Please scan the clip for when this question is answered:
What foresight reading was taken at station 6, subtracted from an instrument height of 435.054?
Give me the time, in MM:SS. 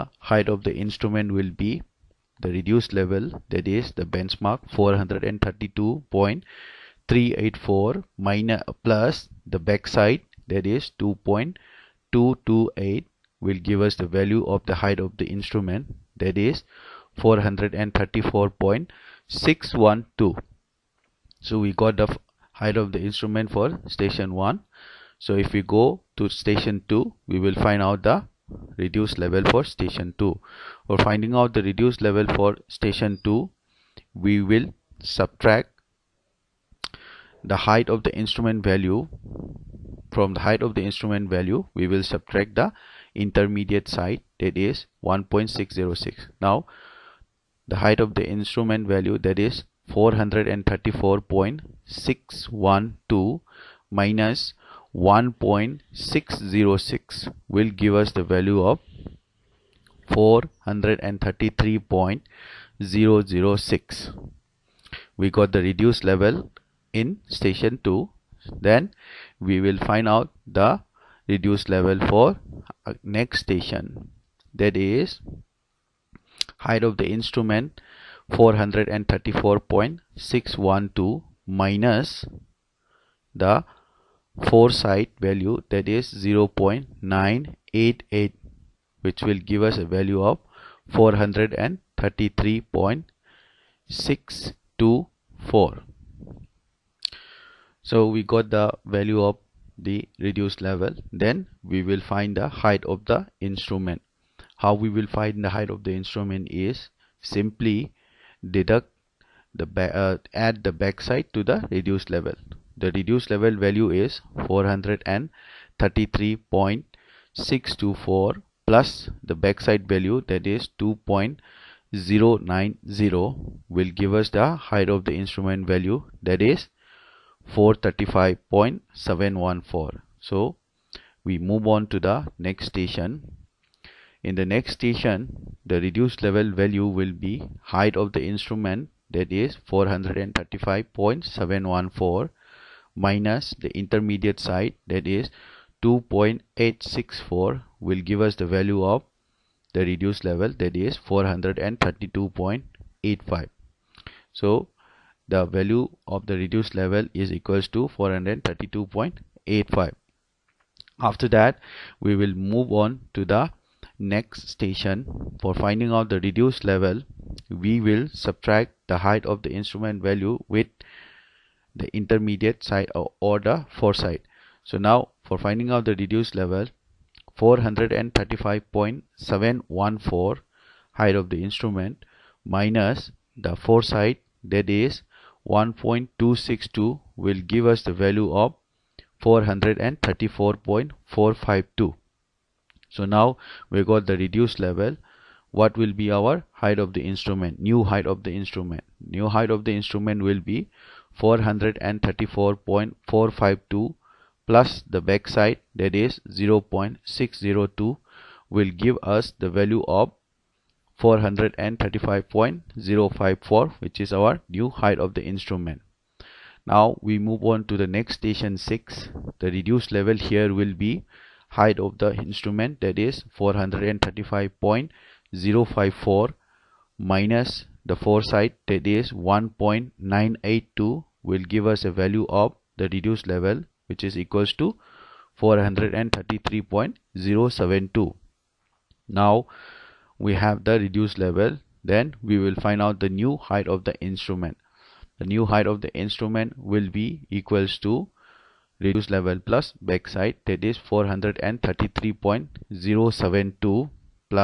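03:49.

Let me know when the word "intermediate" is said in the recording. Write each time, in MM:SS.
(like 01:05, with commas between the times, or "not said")
00:43, 02:23, 02:51.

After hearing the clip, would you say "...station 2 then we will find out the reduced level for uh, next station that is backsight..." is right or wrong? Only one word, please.
wrong.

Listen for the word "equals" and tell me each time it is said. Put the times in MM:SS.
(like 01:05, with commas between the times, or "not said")
02:37, 03:54, 04:07.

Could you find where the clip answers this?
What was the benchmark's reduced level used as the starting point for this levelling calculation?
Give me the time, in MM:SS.
00:04.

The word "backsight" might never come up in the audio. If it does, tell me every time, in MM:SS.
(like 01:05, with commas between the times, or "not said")
00:09, 01:50, 01:59, 03:25, 04:09.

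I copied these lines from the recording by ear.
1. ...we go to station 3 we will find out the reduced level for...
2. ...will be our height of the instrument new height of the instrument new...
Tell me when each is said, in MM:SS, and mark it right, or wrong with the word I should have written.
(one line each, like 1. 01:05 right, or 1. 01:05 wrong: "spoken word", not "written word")
1. 00:25 wrong: "2", not "3"
2. 03:15 right.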